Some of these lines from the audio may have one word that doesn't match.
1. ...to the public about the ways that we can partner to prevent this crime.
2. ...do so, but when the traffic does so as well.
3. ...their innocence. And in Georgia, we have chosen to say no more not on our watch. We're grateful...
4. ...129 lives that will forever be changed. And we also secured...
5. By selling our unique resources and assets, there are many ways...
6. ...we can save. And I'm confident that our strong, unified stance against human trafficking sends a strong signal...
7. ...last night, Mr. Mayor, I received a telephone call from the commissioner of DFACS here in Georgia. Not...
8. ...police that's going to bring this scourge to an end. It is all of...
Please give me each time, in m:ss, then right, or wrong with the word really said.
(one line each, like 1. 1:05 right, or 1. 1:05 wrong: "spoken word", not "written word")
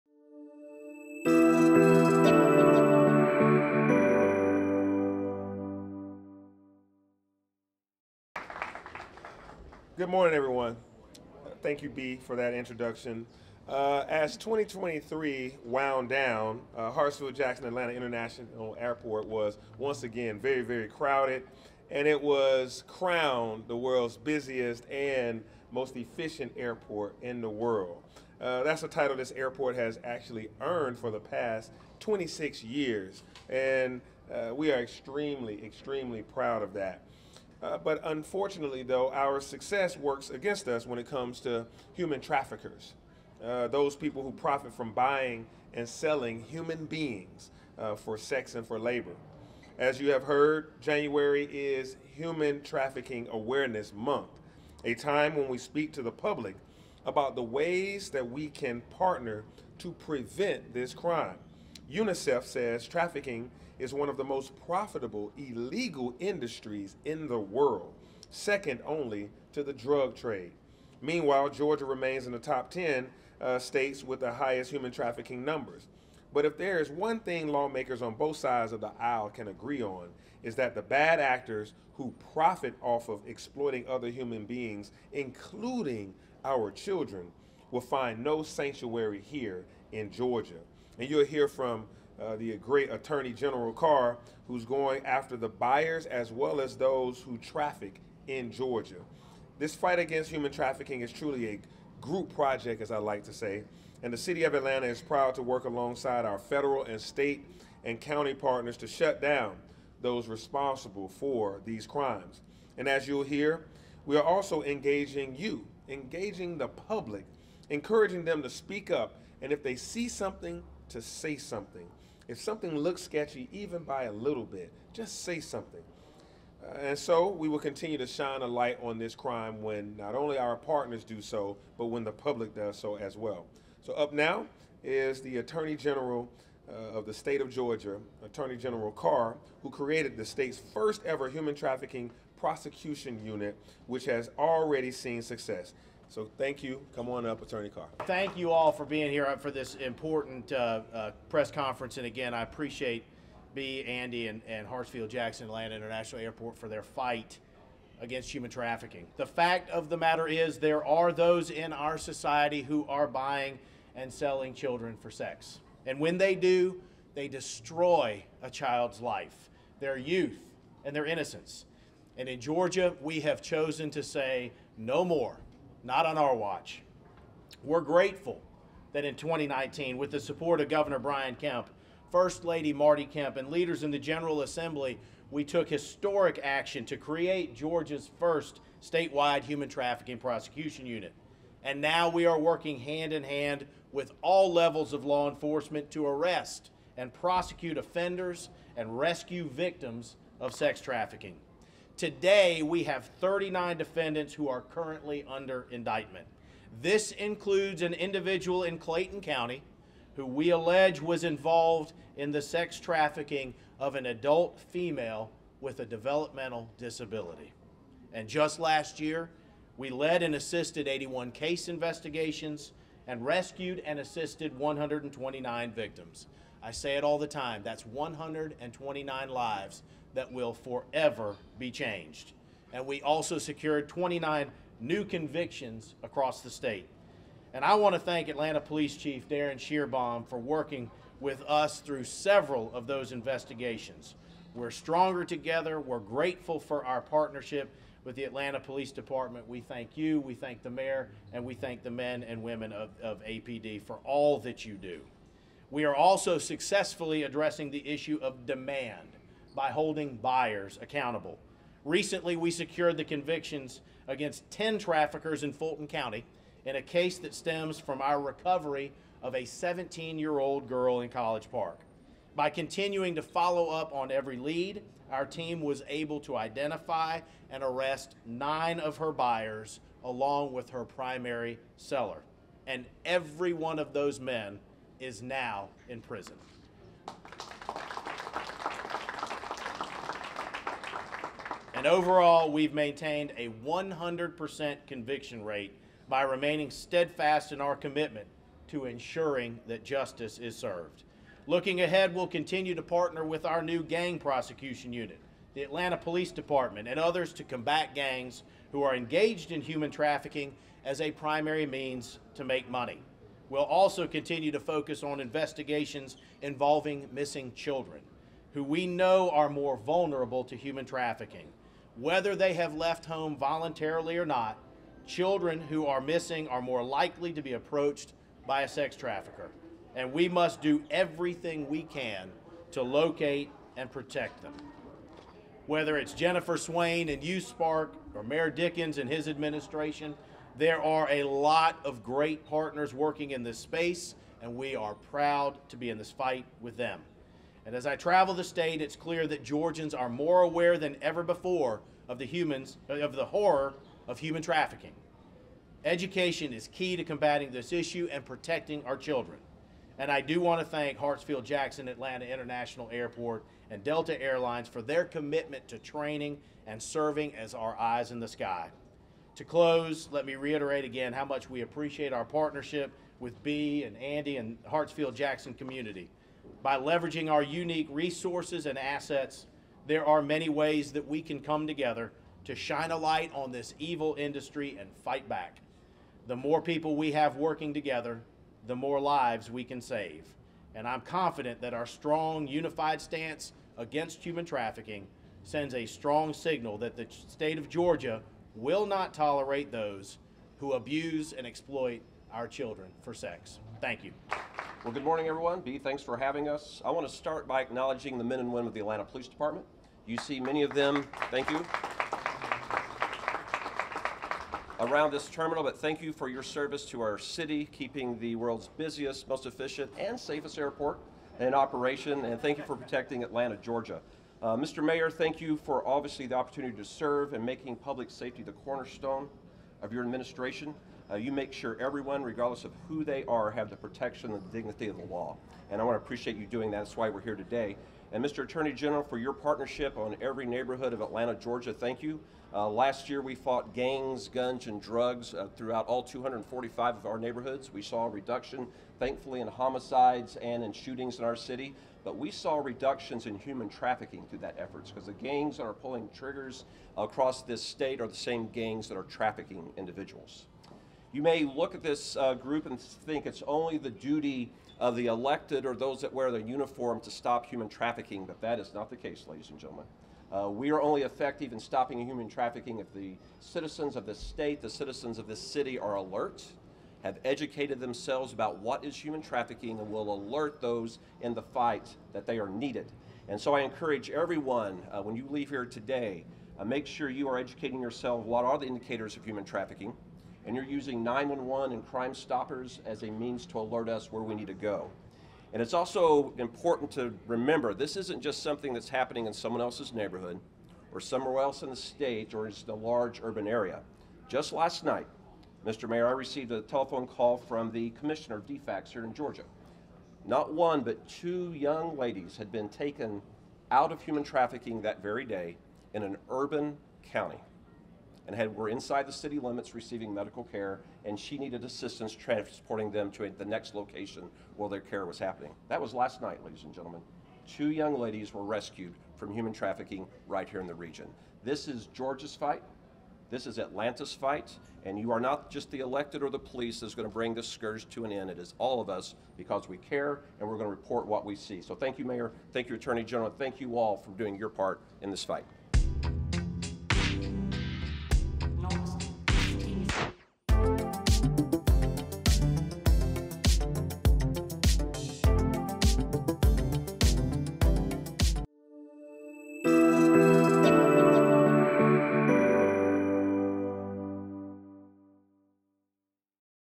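1. 0:55 right
2. 2:11 wrong: "public", not "traffic"
3. 2:50 right
4. 3:47 right
5. 6:16 wrong: "leveraging", not "selling"
6. 6:29 right
7. 8:24 right
8. 8:56 right.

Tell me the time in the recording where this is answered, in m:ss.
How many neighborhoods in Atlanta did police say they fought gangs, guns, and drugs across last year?
7:26.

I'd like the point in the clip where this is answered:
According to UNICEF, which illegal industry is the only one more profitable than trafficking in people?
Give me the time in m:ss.
1:09.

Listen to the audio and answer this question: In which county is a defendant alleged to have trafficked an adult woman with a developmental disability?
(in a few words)
Clayton County.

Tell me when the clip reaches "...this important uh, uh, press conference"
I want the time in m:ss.
2:29.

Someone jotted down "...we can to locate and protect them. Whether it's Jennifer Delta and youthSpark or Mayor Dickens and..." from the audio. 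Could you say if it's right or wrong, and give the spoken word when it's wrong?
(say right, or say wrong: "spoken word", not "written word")
wrong: "Swain", not "Delta".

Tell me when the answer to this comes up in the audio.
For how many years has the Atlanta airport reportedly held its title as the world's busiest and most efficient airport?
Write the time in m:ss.
0:31.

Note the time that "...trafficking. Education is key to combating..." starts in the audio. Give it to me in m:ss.
5:54.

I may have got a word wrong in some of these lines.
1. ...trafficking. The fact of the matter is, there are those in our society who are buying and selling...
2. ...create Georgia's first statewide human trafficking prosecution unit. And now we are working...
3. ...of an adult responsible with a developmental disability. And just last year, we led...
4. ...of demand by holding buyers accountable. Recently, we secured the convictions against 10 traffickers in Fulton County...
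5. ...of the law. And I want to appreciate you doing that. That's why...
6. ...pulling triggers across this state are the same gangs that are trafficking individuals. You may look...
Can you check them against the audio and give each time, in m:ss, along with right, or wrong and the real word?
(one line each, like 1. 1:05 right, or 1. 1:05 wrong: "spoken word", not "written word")
1. 2:38 right
2. 3:06 right
3. 3:33 wrong: "female", not "responsible"
4. 4:18 right
5. 7:14 right
6. 7:35 right.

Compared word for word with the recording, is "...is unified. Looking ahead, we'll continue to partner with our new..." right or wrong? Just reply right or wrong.
wrong.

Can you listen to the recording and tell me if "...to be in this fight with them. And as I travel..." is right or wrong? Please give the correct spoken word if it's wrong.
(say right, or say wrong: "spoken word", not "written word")
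right.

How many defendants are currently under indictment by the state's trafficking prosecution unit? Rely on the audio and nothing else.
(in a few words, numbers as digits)
39.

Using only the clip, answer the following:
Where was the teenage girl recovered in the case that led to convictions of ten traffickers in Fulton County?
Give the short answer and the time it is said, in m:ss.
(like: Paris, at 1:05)
College Park, at 4:31.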